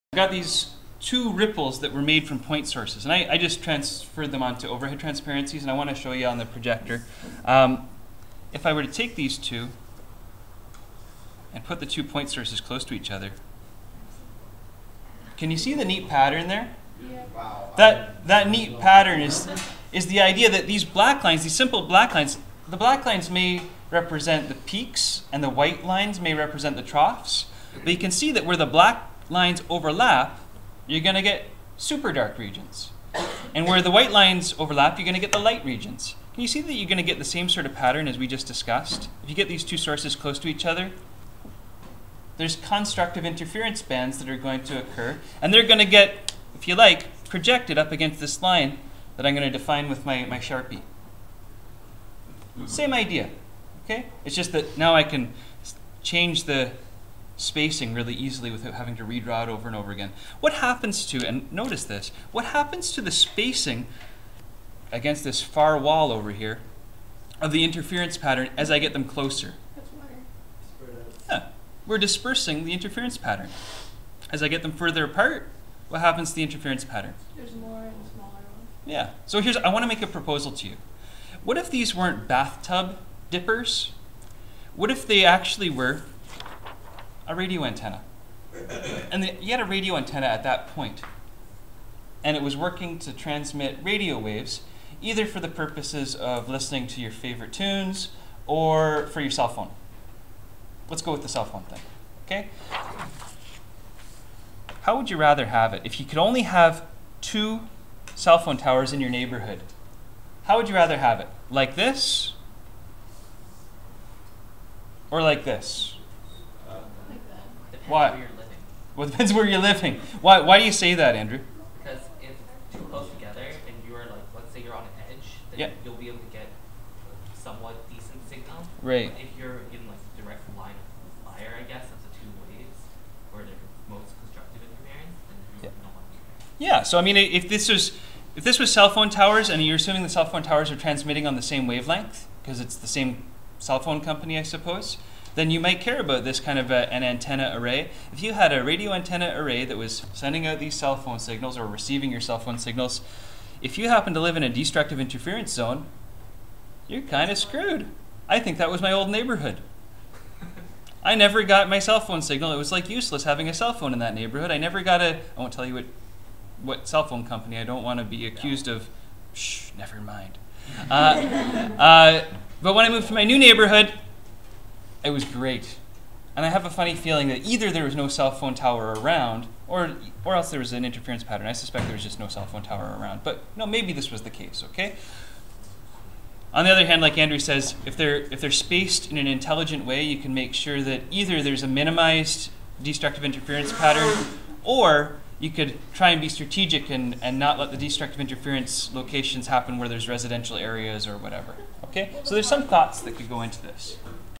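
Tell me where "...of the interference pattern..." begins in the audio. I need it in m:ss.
1:07.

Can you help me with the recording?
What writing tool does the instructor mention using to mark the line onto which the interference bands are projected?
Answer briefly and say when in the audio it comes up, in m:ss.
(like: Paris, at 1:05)
Sharpie, at 0:50.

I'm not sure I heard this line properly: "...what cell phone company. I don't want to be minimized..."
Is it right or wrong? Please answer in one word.
wrong.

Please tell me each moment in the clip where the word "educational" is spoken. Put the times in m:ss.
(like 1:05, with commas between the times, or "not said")
not said.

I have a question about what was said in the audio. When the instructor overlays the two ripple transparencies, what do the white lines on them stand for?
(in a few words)
Troughs.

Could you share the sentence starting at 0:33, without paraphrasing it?
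And where the white lines overlap, you're going to get the light regions.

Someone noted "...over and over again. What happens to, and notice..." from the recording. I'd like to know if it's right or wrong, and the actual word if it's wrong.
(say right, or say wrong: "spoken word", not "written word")
right.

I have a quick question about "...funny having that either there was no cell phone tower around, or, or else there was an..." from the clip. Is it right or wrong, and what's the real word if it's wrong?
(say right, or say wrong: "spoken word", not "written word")
wrong: "feeling", not "having".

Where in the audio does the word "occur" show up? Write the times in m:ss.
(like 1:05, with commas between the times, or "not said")
0:44.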